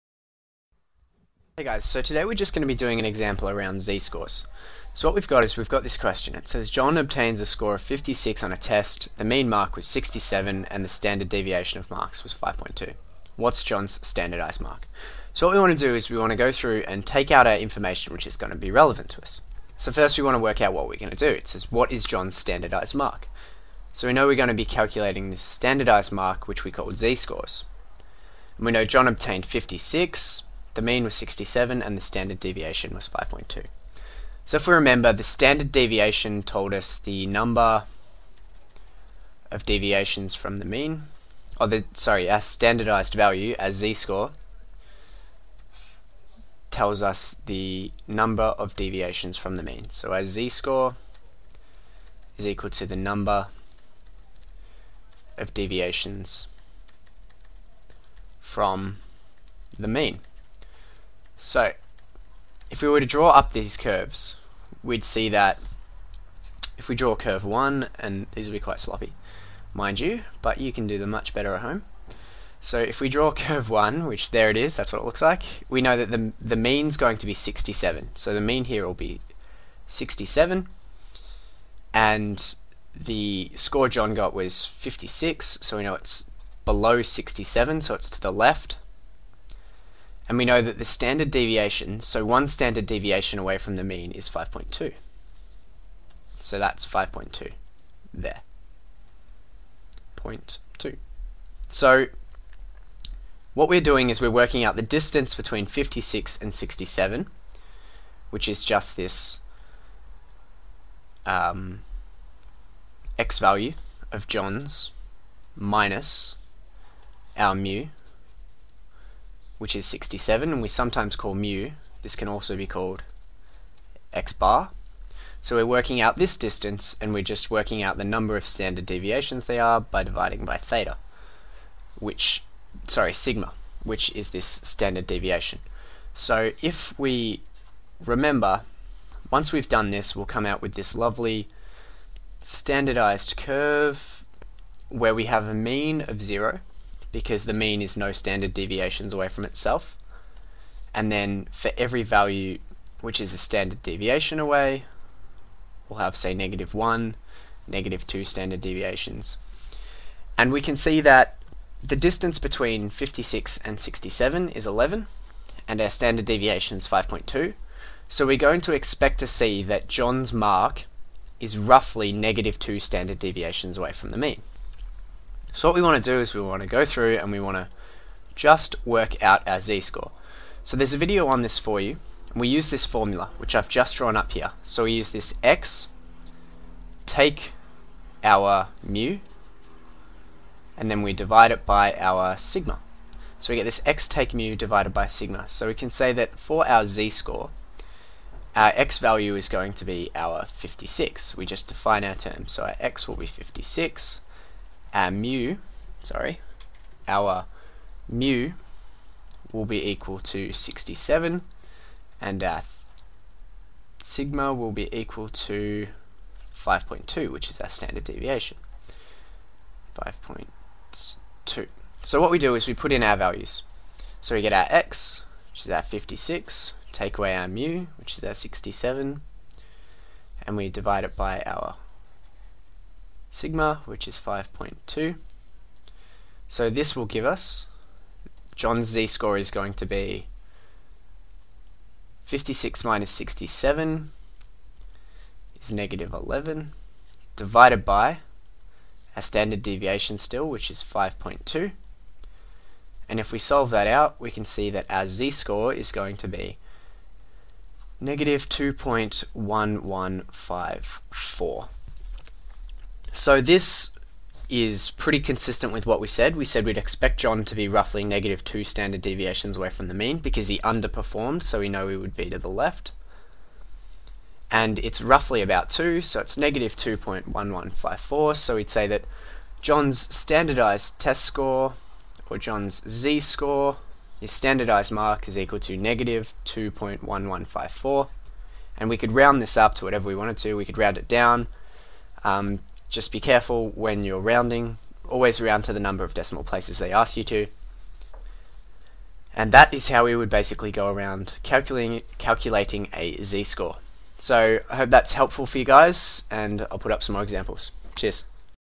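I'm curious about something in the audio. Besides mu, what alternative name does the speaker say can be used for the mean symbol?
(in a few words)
x bar.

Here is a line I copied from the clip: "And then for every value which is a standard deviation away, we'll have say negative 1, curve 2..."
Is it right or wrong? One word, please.
wrong.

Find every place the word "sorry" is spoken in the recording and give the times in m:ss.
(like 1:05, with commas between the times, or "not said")
0:41, 2:12, 3:26.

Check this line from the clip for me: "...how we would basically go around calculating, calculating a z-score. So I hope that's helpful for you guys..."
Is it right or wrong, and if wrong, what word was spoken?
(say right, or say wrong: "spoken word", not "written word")
right.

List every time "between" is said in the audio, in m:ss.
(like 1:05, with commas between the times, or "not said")
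1:45, 2:42.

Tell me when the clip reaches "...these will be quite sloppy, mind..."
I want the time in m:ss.
1:08.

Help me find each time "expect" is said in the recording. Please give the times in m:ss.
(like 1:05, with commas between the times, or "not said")
2:48, 4:26.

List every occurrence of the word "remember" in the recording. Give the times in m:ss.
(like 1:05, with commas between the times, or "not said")
0:34, 2:18.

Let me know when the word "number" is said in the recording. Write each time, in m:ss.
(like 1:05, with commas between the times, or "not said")
0:37, 0:48, 0:52, 2:08, 4:55.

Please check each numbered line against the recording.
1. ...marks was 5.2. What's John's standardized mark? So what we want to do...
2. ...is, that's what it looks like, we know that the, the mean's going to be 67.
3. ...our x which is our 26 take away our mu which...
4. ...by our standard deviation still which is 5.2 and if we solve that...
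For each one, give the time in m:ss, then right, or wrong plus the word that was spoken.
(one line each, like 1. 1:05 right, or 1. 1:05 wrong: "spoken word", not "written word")
1. 0:11 right
2. 1:14 right
3. 3:44 wrong: "56", not "26"
4. 4:07 right.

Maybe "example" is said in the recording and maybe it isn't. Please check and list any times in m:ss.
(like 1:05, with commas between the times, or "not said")
0:03, 5:07.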